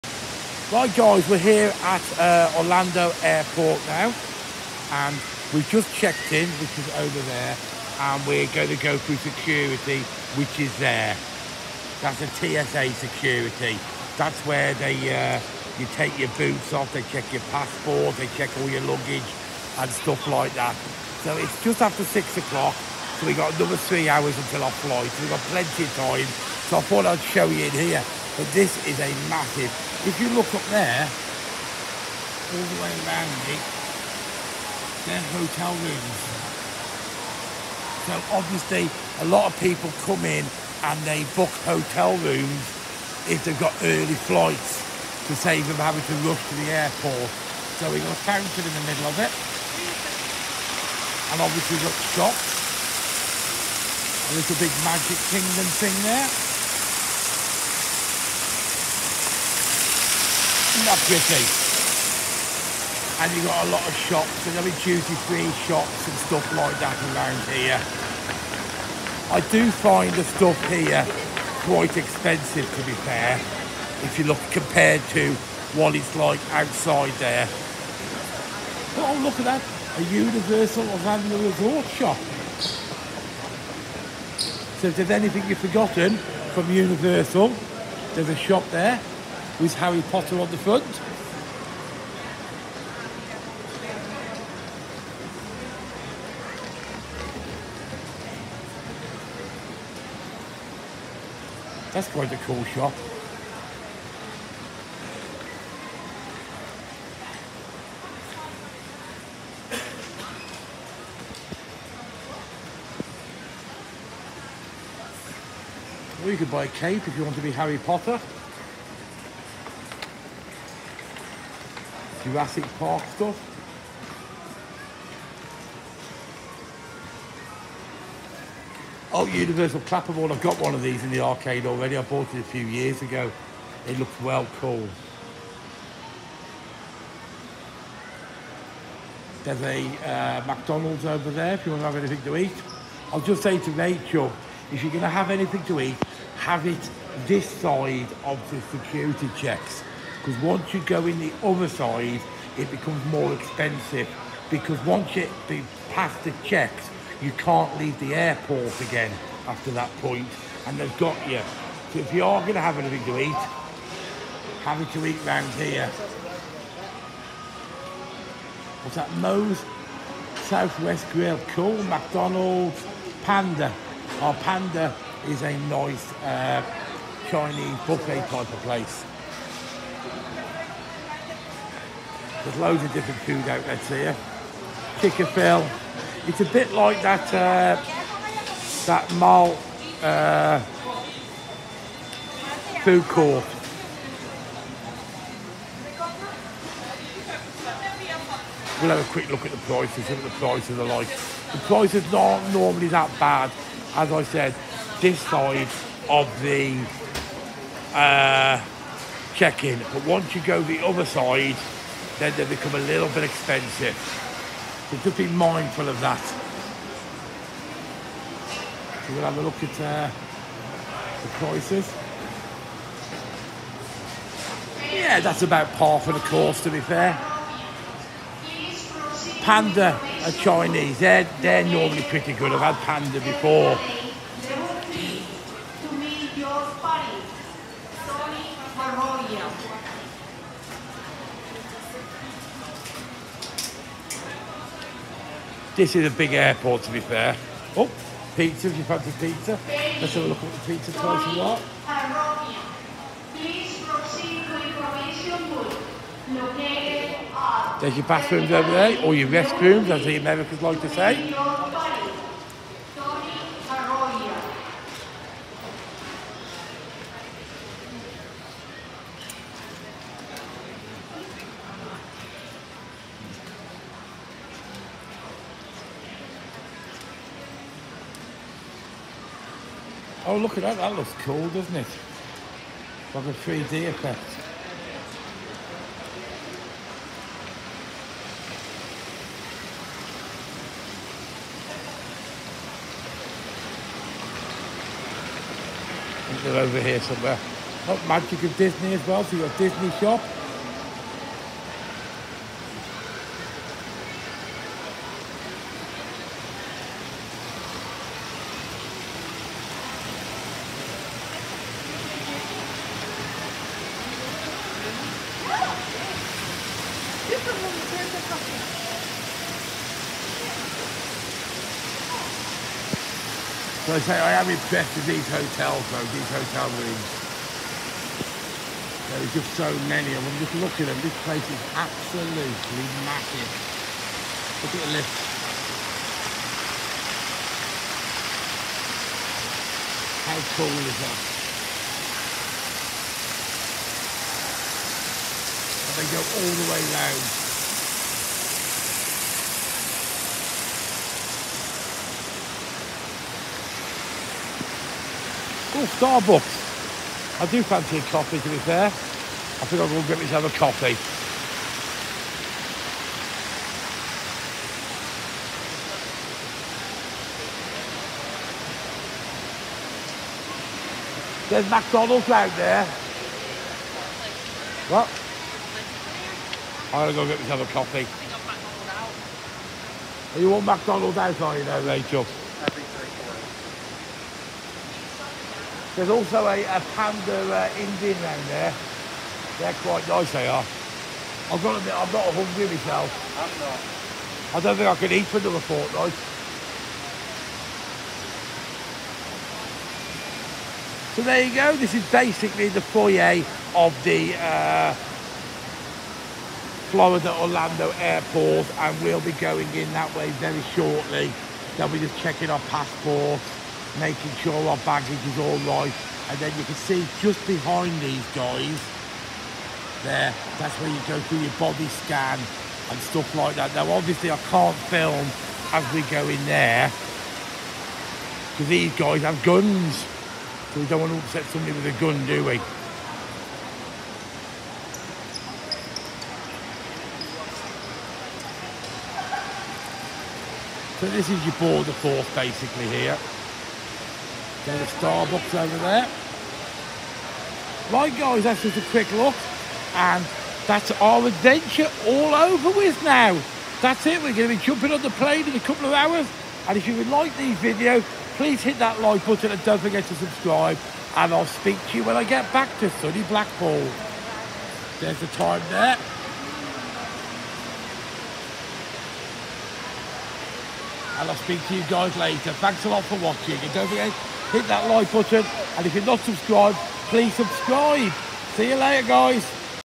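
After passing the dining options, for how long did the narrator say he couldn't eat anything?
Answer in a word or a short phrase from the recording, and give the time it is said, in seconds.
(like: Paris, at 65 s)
Another fortnight, at 395 s.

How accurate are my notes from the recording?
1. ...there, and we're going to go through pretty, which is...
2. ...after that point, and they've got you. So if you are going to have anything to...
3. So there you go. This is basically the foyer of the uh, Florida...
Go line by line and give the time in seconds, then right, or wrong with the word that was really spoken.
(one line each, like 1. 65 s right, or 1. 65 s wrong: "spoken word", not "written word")
1. 7 s wrong: "security", not "pretty"
2. 159 s right
3. 401 s right.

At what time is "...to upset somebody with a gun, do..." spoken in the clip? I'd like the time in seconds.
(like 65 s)
431 s.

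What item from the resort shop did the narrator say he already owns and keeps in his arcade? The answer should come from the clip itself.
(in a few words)
Universal Clapperboard.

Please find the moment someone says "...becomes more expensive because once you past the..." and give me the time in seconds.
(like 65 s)
152 s.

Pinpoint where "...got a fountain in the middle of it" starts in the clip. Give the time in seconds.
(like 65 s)
48 s.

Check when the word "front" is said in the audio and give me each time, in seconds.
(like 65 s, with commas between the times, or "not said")
90 s.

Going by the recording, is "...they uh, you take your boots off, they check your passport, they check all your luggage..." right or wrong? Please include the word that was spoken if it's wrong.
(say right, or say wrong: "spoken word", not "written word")
right.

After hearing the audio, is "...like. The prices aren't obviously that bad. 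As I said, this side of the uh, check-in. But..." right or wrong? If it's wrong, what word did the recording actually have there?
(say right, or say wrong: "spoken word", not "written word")
wrong: "normally", not "obviously".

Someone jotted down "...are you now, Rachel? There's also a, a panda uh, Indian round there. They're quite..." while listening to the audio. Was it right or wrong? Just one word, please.
right.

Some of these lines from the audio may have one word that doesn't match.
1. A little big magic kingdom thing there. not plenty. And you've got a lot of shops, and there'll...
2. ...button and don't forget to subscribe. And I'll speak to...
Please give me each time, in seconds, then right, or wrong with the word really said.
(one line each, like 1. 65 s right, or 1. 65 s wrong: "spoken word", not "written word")
1. 54 s wrong: "pretty", not "plenty"
2. 459 s right.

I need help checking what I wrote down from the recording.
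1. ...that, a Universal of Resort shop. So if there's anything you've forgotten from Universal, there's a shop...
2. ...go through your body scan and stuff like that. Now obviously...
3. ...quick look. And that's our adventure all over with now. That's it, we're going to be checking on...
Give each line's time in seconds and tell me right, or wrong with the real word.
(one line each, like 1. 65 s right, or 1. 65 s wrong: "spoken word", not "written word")
1. 79 s right
2. 421 s right
3. 448 s wrong: "jumping", not "checking".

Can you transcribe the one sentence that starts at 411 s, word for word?
They'll be just checking our passports, making sure our baggage is all right.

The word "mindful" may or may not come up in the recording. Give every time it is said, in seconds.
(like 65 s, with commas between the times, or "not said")
215 s.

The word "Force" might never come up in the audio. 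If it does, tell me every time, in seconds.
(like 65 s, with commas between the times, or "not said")
441 s.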